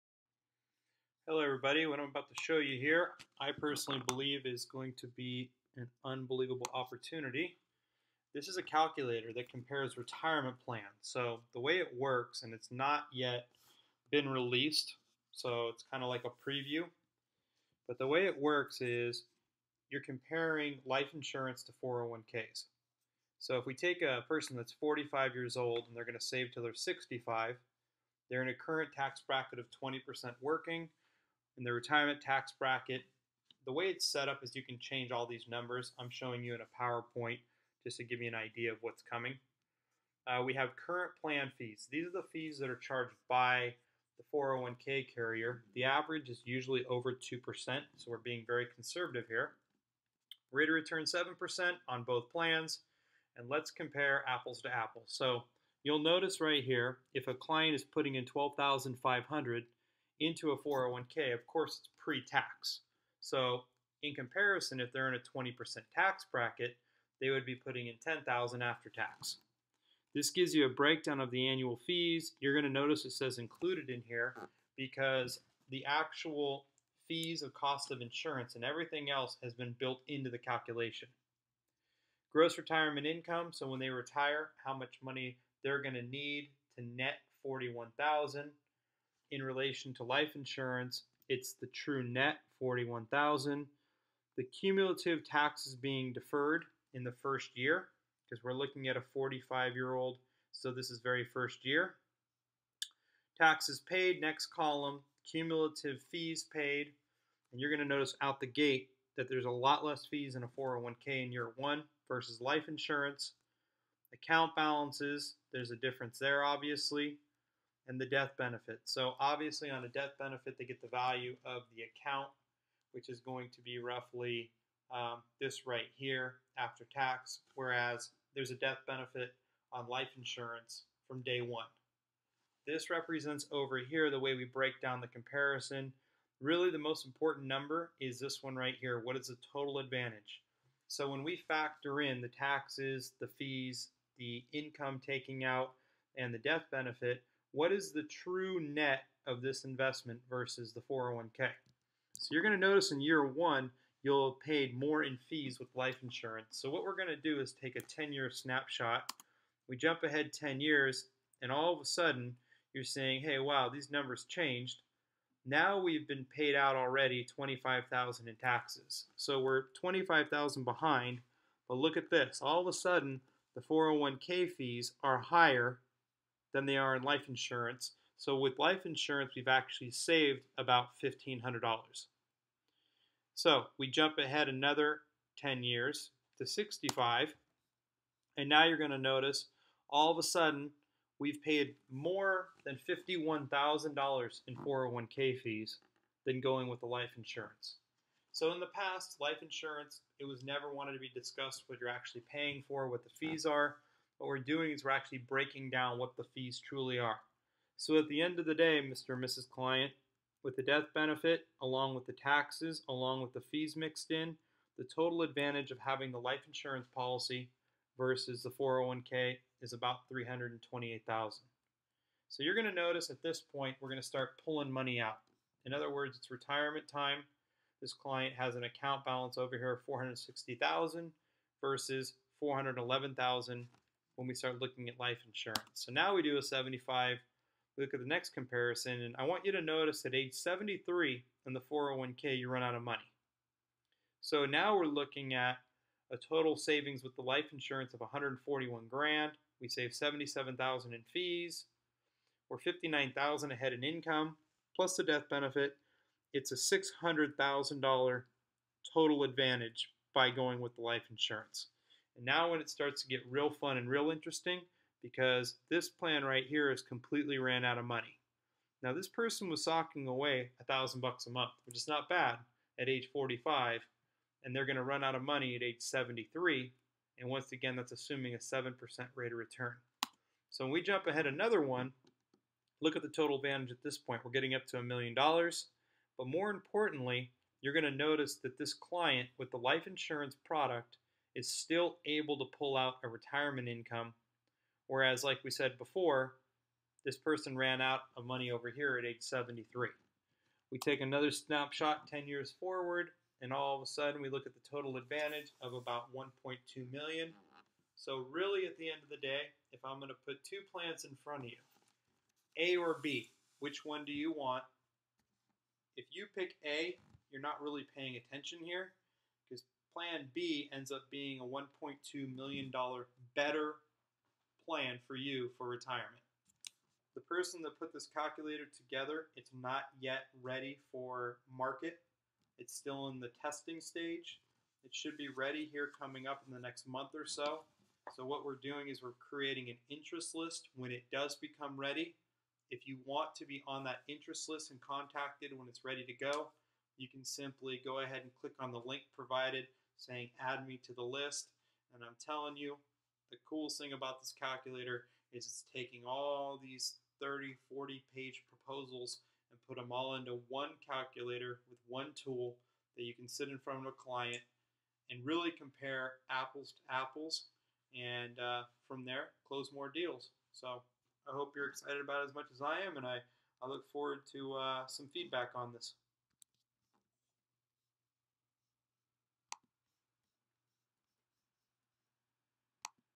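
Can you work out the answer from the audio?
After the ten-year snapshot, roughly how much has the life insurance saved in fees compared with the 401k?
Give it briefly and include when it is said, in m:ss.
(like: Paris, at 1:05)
$1,500, at 3:01.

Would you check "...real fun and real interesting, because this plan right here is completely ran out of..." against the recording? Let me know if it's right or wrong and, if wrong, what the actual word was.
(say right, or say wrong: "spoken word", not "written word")
right.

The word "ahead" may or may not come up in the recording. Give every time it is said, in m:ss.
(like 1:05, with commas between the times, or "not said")
2:40, 3:04, 4:13, 4:41, 5:47.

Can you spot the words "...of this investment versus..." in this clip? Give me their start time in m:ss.
2:29.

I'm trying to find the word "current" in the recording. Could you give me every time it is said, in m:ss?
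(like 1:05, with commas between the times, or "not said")
0:28, 0:40.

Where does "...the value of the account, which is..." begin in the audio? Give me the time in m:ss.
2:00.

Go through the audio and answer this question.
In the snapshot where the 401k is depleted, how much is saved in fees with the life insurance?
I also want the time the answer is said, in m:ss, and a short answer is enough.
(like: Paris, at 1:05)
77,000, at 4:09.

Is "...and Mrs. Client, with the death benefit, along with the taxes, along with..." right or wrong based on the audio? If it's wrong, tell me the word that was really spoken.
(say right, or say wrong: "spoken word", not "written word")
right.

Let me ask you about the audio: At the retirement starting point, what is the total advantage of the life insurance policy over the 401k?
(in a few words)
328,000.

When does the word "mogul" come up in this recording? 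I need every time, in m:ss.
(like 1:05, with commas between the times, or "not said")
not said.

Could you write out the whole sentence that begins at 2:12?
This represents over here the way we break down the comparison.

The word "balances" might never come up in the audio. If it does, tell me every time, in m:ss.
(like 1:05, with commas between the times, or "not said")
1:54, 3:49.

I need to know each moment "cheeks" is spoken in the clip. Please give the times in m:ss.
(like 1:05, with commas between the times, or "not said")
not said.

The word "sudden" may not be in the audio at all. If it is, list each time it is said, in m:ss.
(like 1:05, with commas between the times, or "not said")
2:41, 2:52, 3:10, 5:03.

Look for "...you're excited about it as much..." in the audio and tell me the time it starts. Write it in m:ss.
6:11.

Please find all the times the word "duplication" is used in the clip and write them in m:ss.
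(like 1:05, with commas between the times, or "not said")
not said.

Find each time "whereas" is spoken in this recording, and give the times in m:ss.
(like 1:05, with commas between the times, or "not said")
2:07, 4:54.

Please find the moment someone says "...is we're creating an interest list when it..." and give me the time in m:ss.
5:38.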